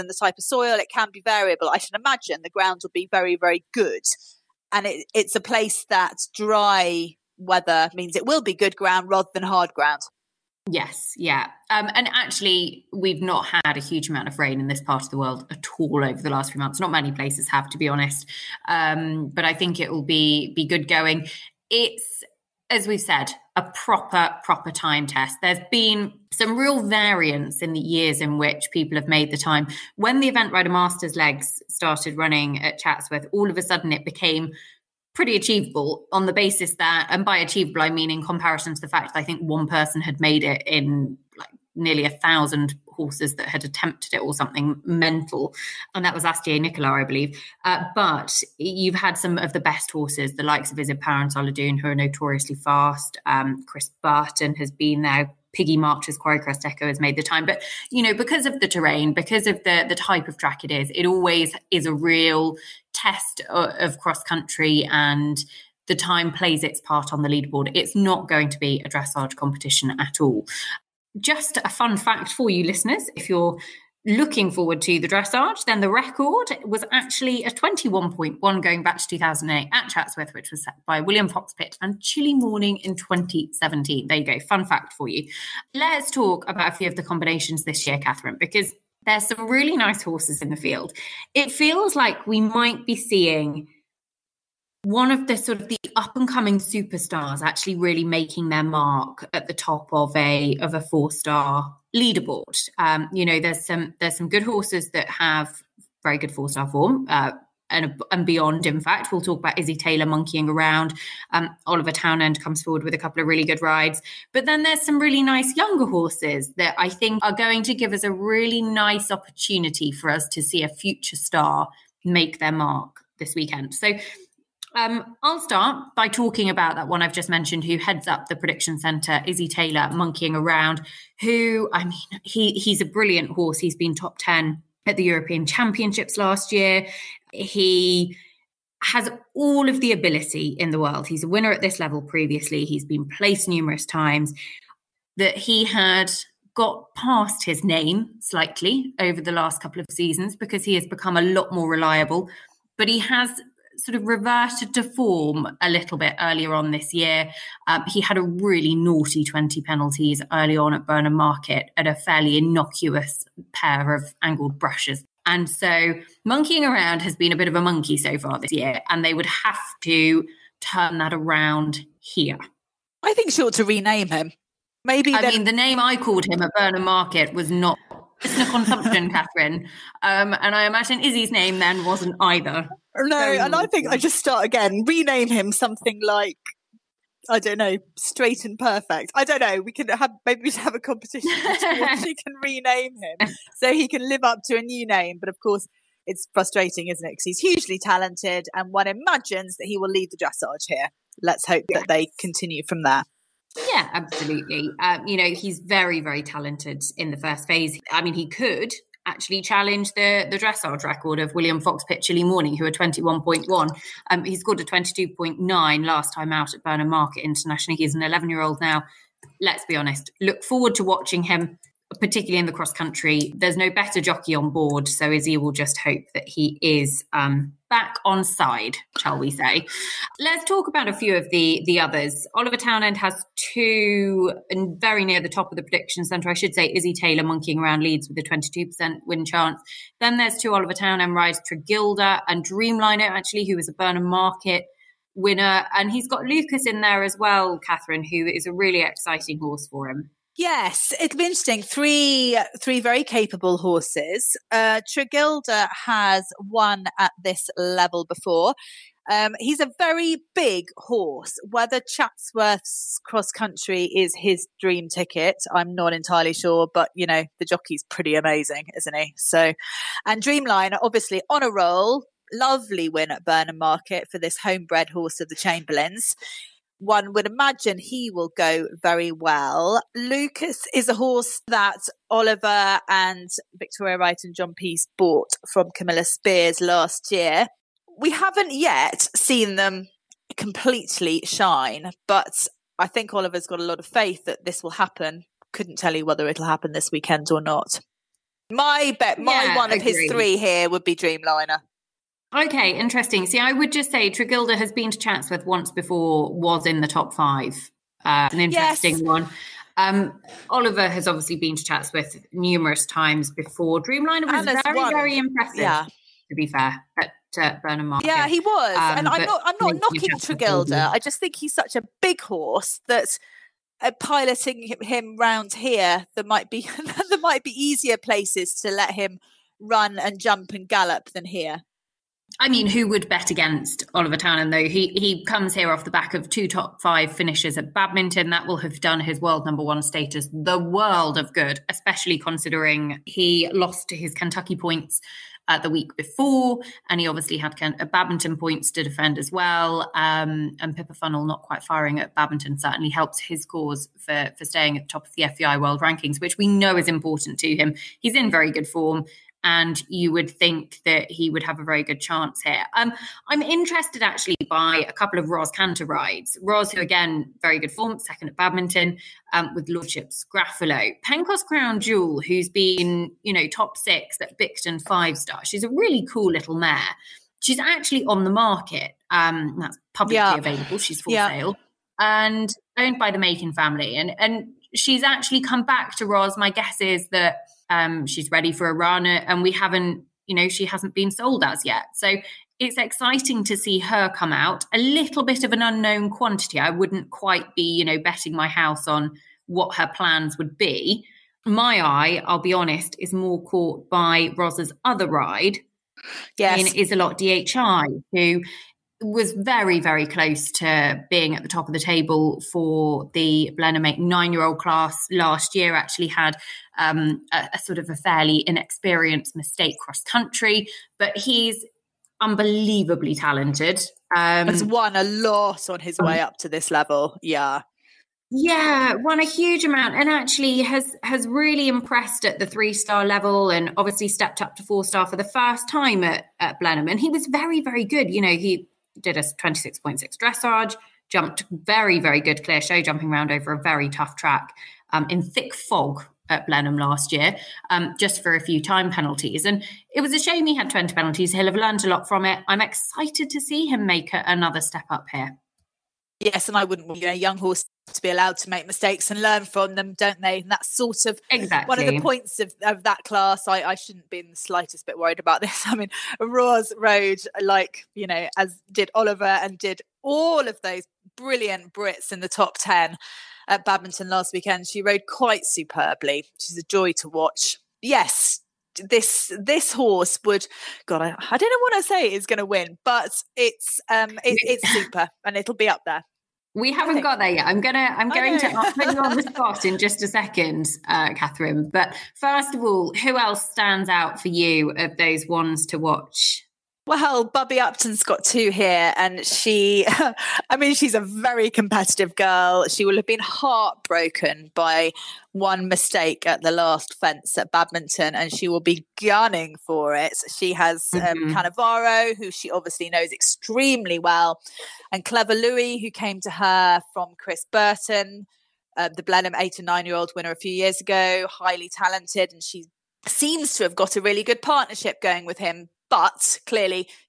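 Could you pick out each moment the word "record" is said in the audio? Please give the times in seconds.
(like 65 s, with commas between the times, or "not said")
75 s, 210 s.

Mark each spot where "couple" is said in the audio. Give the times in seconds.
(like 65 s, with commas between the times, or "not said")
112 s, 149 s, 364 s.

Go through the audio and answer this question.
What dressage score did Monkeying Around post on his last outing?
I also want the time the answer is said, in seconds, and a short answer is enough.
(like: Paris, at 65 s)
22.9, at 214 s.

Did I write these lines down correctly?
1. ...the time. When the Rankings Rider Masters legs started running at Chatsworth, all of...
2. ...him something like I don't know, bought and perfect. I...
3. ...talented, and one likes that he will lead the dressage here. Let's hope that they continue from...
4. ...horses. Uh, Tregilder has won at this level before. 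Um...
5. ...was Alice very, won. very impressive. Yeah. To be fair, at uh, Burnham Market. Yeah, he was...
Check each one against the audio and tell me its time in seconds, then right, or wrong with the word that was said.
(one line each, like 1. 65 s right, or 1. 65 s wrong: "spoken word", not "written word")
1. 29 s wrong: "Event", not "Rankings"
2. 185 s wrong: "straight", not "bought"
3. 197 s wrong: "imagines", not "likes"
4. 253 s right
5. 314 s right.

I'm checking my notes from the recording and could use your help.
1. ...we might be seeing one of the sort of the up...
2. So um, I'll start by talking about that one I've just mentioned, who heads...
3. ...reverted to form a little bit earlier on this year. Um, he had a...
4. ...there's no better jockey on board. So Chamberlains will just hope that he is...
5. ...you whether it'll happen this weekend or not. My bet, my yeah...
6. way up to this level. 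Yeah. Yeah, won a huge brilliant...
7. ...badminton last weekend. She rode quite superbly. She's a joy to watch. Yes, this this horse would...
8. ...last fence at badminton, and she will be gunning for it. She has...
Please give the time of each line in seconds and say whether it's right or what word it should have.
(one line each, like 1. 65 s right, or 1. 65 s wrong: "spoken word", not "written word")
1. 92 s right
2. 123 s right
3. 154 s right
4. 223 s wrong: "Izzy", not "Chamberlains"
5. 295 s right
6. 426 s wrong: "amount", not "brilliant"
7. 473 s right
8. 506 s right.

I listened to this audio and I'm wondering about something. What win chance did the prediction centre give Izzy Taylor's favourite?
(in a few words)
22%.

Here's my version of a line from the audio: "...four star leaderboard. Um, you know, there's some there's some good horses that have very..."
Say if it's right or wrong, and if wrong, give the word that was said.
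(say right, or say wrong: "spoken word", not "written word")
right.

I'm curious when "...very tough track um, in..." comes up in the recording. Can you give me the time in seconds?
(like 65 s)
443 s.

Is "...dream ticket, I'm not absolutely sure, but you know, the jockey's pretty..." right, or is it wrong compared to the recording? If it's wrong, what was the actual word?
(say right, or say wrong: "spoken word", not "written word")
wrong: "entirely", not "absolutely".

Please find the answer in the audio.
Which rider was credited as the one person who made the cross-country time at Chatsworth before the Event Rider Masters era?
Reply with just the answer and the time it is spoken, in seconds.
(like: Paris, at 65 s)
Astier Nicolas, at 46 s.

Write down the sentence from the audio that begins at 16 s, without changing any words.
Not many places have, to be honest.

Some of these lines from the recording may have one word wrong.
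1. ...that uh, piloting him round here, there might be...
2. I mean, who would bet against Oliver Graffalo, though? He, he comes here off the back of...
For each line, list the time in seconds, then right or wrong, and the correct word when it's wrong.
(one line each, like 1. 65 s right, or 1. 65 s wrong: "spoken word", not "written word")
1. 322 s right
2. 332 s wrong: "Townend", not "Graffalo".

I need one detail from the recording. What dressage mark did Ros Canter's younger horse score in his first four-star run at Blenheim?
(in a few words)
26.6.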